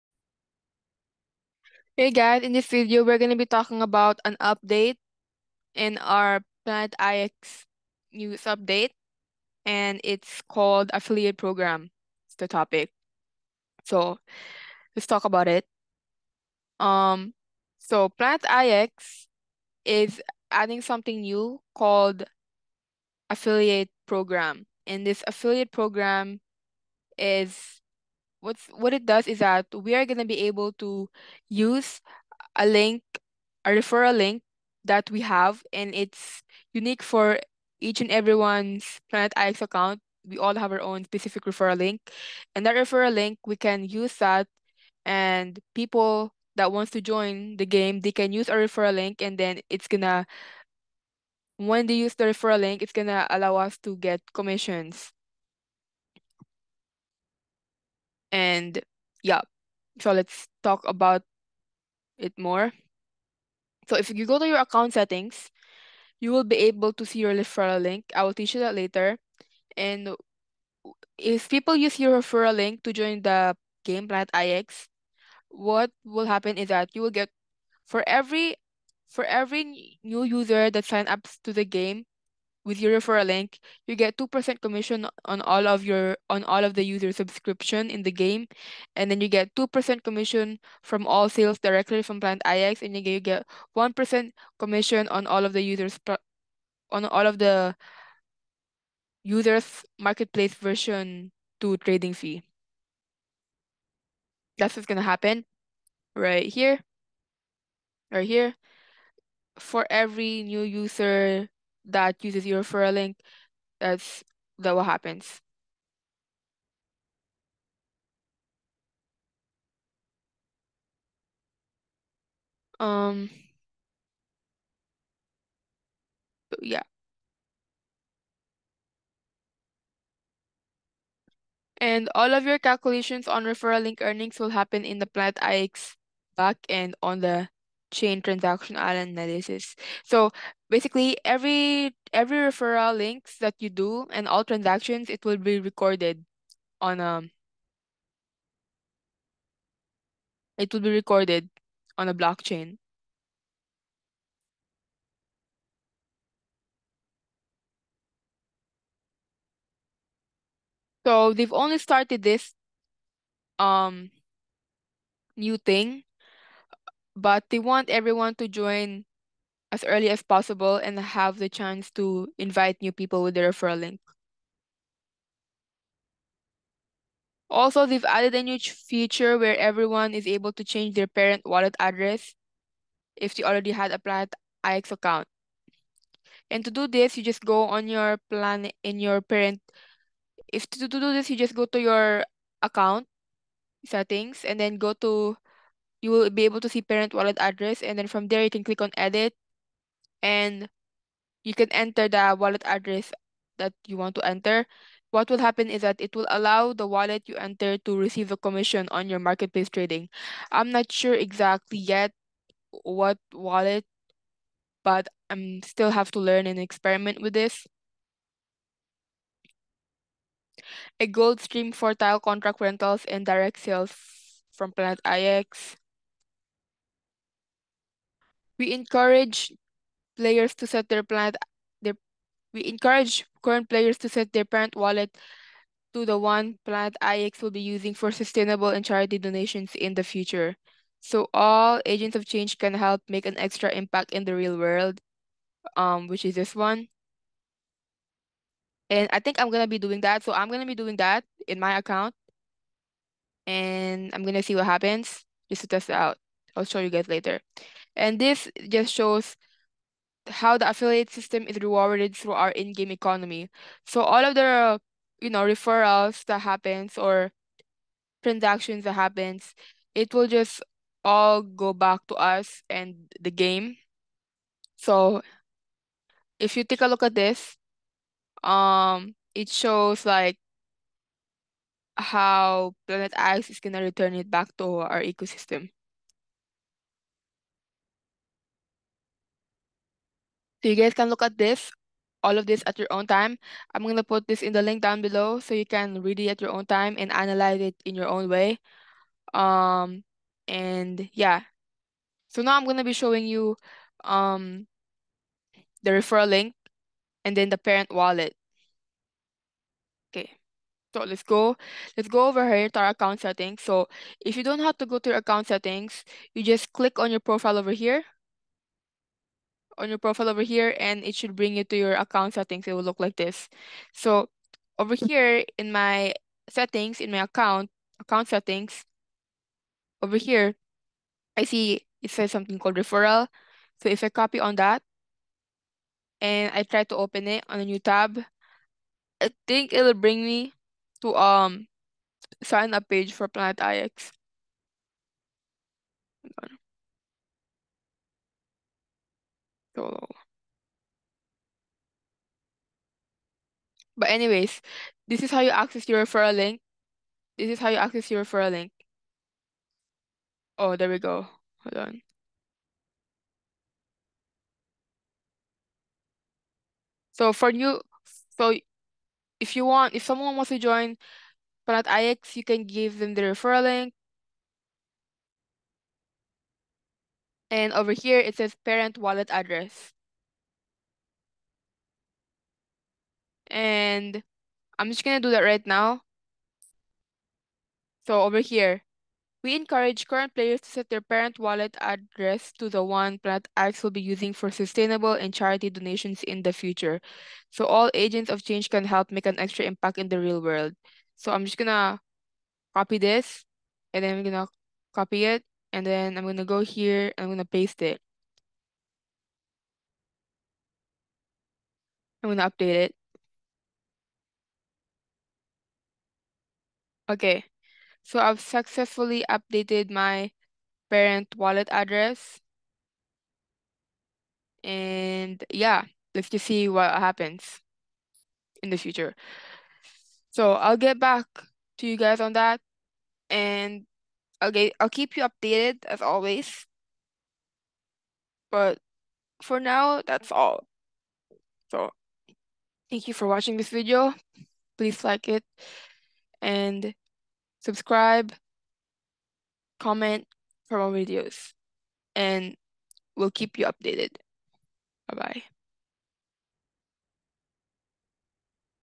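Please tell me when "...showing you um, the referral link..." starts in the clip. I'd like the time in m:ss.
5:02.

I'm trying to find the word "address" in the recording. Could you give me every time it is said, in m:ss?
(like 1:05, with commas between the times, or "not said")
3:01, 3:17, 3:22, 6:19, 6:31, 7:01.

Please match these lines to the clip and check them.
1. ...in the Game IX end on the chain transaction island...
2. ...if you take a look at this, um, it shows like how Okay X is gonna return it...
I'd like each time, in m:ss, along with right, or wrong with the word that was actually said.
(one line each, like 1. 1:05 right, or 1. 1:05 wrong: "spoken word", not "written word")
1. 2:14 wrong: "Planet", not "Game"
2. 4:36 wrong: "Planet", not "Okay".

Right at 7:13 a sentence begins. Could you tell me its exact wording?
And Okay, I'll keep you updated as always.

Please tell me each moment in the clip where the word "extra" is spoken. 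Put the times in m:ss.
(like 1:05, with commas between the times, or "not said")
4:03, 6:39.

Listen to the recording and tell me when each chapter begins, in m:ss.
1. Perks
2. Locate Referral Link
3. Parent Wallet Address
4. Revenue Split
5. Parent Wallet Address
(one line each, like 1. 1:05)
1. 1:12
2. 5:08
3. 3:03
4. 4:23
5. 6:20.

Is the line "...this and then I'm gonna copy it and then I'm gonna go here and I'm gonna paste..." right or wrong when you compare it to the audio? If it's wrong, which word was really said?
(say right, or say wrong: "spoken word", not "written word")
right.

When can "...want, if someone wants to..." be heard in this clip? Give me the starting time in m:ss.
6:09.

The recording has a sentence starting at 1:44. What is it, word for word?
That's what's going to happen right here.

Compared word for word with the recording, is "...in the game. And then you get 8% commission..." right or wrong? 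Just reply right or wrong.
wrong.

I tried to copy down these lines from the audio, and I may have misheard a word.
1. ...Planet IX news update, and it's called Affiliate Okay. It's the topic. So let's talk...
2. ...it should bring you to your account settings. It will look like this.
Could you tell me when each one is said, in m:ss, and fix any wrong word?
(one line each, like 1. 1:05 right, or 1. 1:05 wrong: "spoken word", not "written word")
1. 0:06 wrong: "Program", not "Okay"
2. 5:21 right.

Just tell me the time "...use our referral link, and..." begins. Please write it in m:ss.
0:48.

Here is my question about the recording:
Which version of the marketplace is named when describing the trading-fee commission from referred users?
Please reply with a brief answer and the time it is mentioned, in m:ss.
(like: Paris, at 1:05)
version 2, at 1:40.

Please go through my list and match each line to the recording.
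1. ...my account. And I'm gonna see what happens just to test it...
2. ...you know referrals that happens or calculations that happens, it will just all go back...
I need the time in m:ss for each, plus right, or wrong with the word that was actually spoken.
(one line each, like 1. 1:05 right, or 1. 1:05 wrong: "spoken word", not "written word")
1. 4:11 right
2. 4:25 wrong: "transactions", not "calculations".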